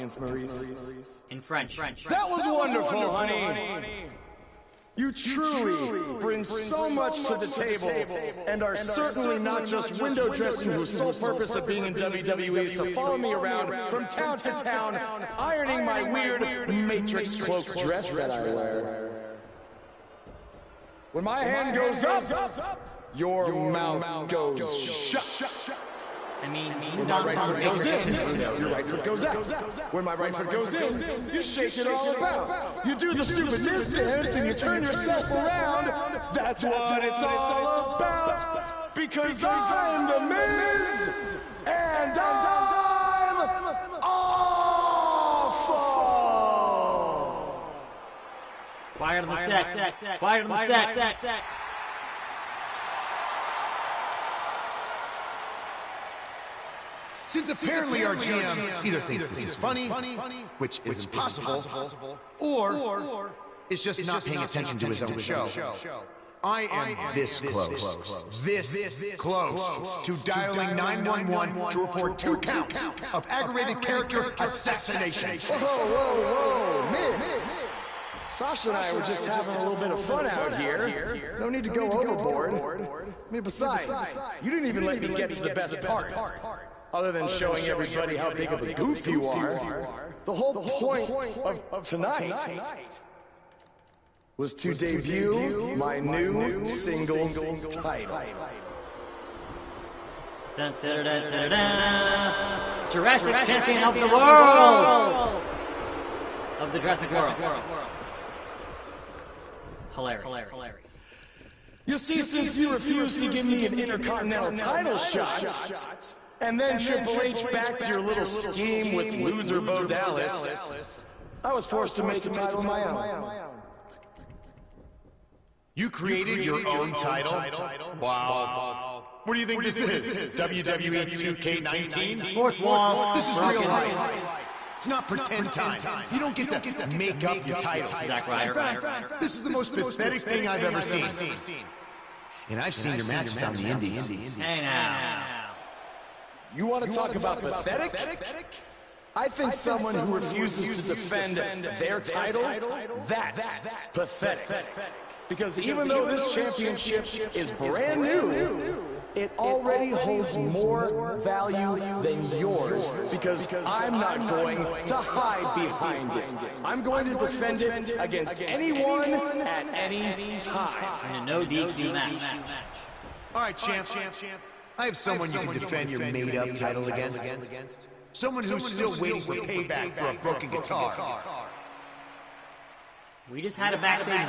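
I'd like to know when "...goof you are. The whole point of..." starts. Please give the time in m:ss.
1:28.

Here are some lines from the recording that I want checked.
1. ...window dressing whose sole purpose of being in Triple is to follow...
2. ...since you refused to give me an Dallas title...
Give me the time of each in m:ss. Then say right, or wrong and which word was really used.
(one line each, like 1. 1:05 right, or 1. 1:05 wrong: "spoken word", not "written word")
1. 0:09 wrong: "WWE", not "Triple"
2. 1:52 wrong: "Intercontinental", not "Dallas".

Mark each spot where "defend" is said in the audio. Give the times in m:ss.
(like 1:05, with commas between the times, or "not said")
2:30, 2:47, 2:55.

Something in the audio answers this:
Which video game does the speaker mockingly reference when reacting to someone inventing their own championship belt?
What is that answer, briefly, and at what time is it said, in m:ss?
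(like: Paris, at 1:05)
WWE 2K19, at 2:10.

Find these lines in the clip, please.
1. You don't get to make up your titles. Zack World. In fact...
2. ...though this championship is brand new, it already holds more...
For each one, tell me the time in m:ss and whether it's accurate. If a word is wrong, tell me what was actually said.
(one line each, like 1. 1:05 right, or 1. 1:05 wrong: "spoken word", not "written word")
1. 2:16 wrong: "Ryder", not "World"
2. 2:35 right.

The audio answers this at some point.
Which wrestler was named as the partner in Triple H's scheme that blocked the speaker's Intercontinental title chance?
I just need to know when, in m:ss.
1:59.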